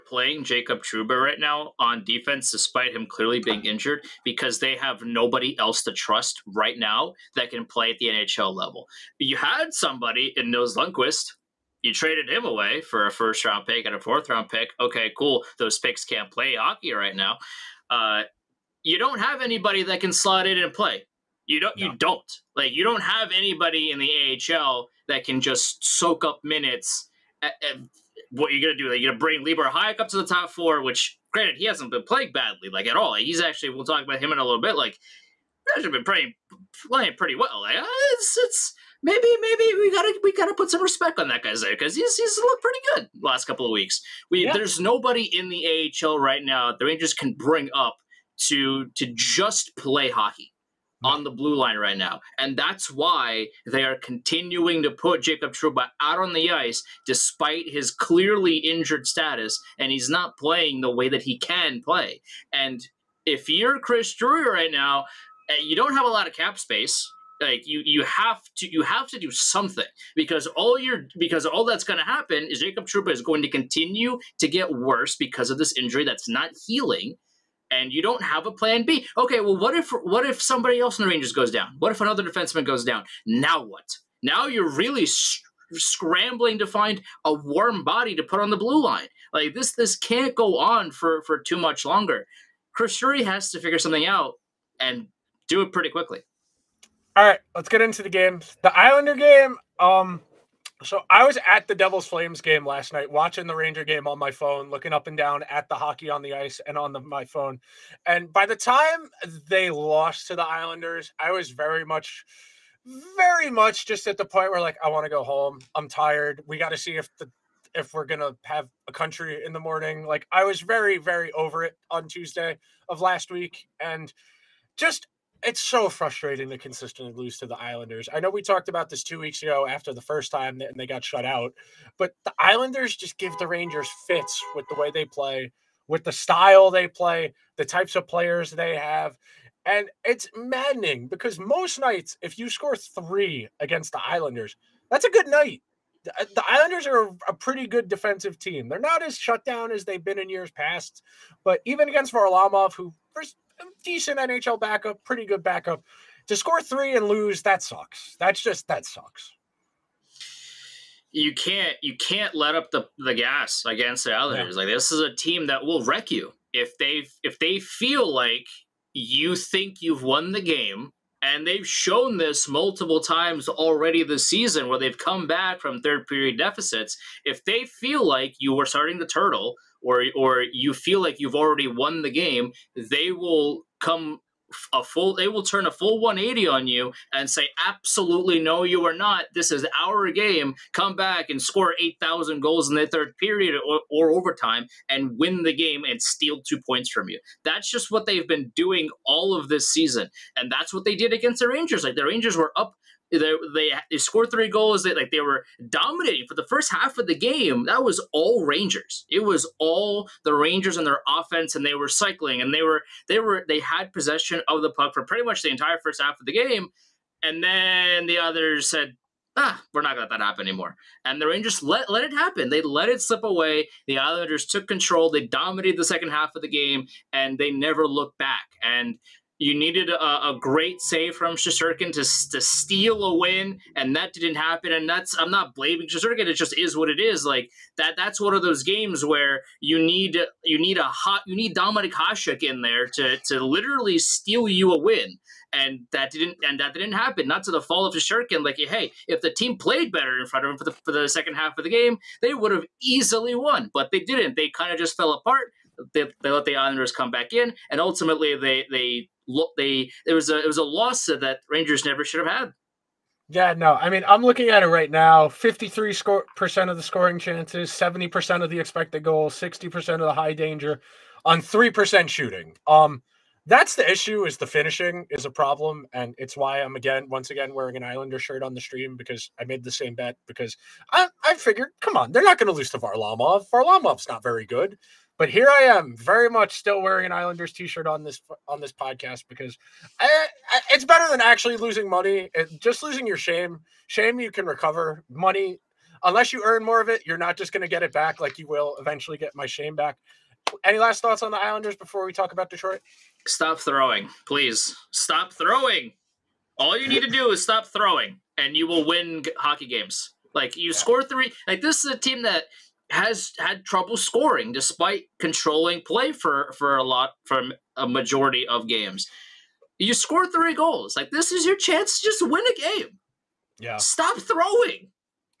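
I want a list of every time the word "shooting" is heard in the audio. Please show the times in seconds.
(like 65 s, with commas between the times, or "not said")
272 s.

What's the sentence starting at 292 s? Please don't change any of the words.
It, just losing your shame, shame you can recover.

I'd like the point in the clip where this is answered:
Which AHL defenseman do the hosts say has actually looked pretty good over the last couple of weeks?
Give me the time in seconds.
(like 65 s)
29 s.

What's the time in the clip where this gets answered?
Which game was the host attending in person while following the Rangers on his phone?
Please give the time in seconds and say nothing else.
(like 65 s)
101 s.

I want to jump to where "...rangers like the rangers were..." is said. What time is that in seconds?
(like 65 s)
201 s.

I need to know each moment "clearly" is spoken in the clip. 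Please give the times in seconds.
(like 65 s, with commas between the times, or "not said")
3 s, 57 s.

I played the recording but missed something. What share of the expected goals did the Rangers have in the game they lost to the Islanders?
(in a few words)
70%.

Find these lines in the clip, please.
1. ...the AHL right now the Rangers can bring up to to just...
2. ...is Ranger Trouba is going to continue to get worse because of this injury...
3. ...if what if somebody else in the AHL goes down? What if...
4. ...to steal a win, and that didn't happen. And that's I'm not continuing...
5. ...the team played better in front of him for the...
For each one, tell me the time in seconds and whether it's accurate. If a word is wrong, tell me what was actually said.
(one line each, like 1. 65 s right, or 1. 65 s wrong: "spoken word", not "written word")
1. 45 s right
2. 72 s wrong: "Jacob", not "Ranger"
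3. 79 s wrong: "Rangers", not "AHL"
4. 232 s wrong: "blaming", not "continuing"
5. 249 s right.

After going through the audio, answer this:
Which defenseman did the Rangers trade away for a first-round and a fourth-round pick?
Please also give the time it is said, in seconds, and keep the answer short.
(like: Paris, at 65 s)
Nils Lundqvist, at 10 s.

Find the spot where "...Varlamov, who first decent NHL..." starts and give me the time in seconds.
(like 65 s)
152 s.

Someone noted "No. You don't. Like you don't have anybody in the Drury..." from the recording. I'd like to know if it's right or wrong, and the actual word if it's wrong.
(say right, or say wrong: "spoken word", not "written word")
wrong: "AHL", not "Drury".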